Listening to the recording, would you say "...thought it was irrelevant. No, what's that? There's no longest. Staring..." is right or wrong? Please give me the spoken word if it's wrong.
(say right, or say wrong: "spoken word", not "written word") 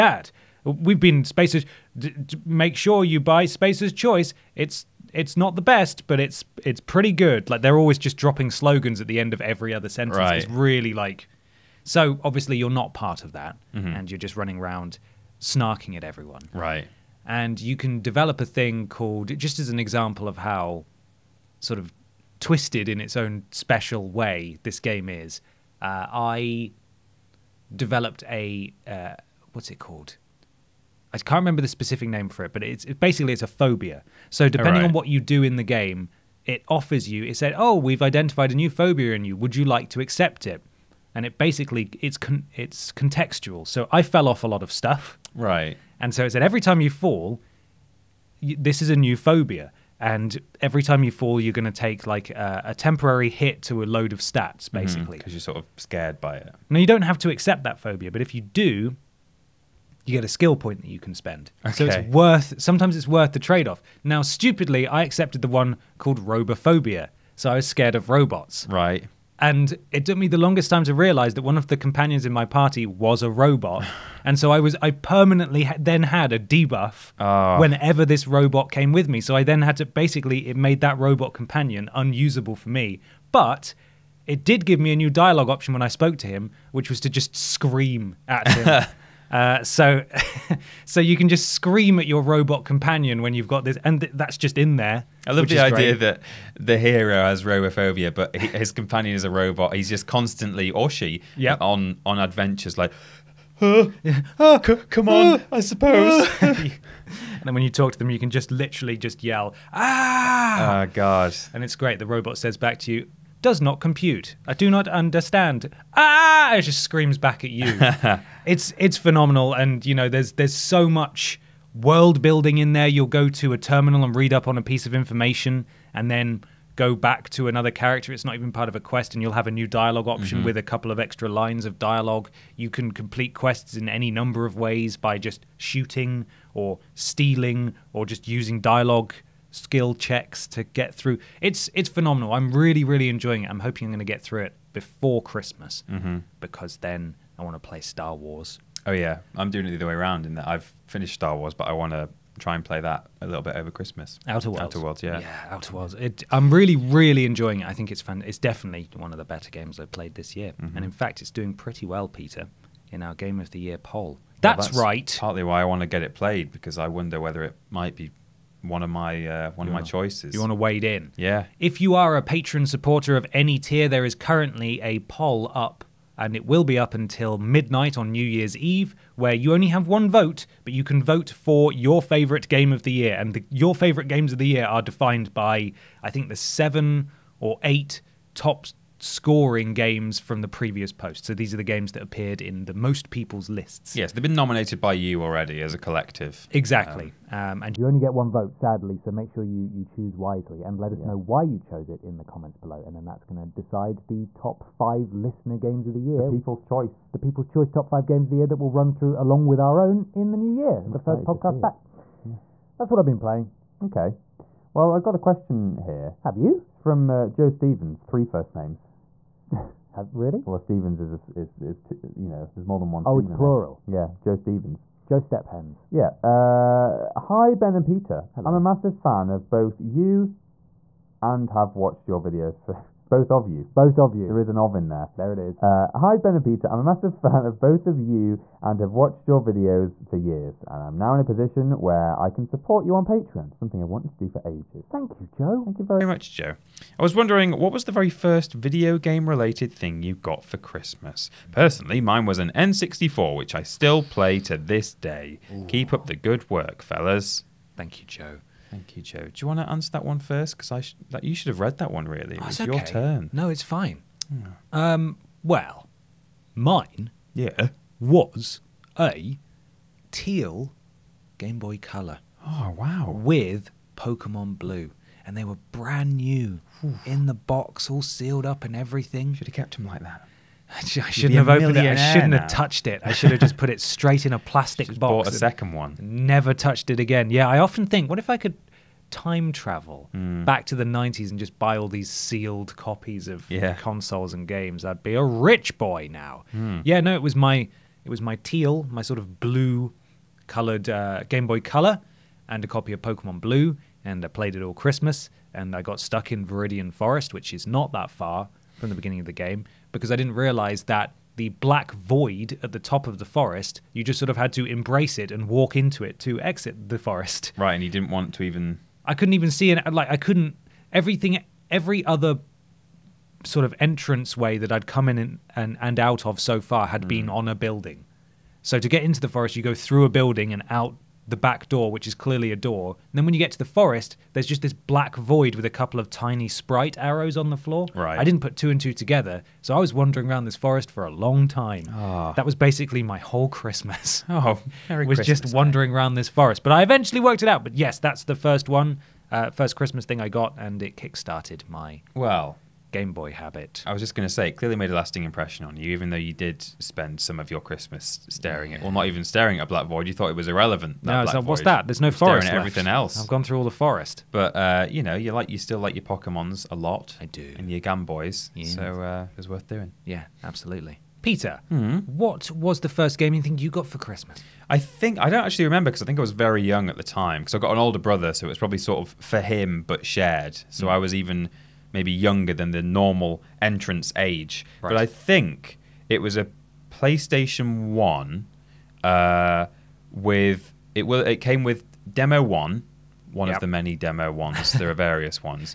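wrong: "forest", not "longest".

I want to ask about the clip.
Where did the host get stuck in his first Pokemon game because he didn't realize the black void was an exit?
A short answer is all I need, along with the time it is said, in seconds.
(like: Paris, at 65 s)
Viridian Forest, at 306 s.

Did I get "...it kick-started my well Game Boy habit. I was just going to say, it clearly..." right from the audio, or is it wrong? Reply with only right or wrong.
right.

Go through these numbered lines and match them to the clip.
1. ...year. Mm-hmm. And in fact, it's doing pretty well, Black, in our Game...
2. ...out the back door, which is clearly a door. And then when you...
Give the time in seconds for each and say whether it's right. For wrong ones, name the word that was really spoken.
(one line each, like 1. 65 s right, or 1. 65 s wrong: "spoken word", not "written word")
1. 160 s wrong: "Peter", not "Black"
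2. 330 s right.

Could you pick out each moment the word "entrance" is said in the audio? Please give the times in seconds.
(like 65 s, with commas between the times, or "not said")
323 s, 383 s.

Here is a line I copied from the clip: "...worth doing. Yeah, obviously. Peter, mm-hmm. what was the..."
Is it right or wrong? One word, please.
wrong.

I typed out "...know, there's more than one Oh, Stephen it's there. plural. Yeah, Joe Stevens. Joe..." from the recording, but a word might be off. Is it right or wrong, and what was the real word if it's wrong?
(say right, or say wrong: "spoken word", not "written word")
right.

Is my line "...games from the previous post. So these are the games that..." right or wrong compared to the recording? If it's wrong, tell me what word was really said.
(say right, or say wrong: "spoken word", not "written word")
right.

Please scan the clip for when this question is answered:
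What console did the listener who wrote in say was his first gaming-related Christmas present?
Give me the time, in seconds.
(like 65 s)
252 s.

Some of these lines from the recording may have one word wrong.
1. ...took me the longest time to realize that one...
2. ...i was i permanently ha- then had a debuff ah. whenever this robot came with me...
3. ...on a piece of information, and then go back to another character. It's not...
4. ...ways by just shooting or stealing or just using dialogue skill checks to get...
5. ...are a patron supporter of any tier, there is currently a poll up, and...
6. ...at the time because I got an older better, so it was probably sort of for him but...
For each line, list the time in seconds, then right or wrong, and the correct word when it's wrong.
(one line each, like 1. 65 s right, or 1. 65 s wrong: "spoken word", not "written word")
1. 70 s right
2. 74 s right
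3. 124 s right
4. 134 s right
5. 171 s right
6. 376 s wrong: "brother", not "better".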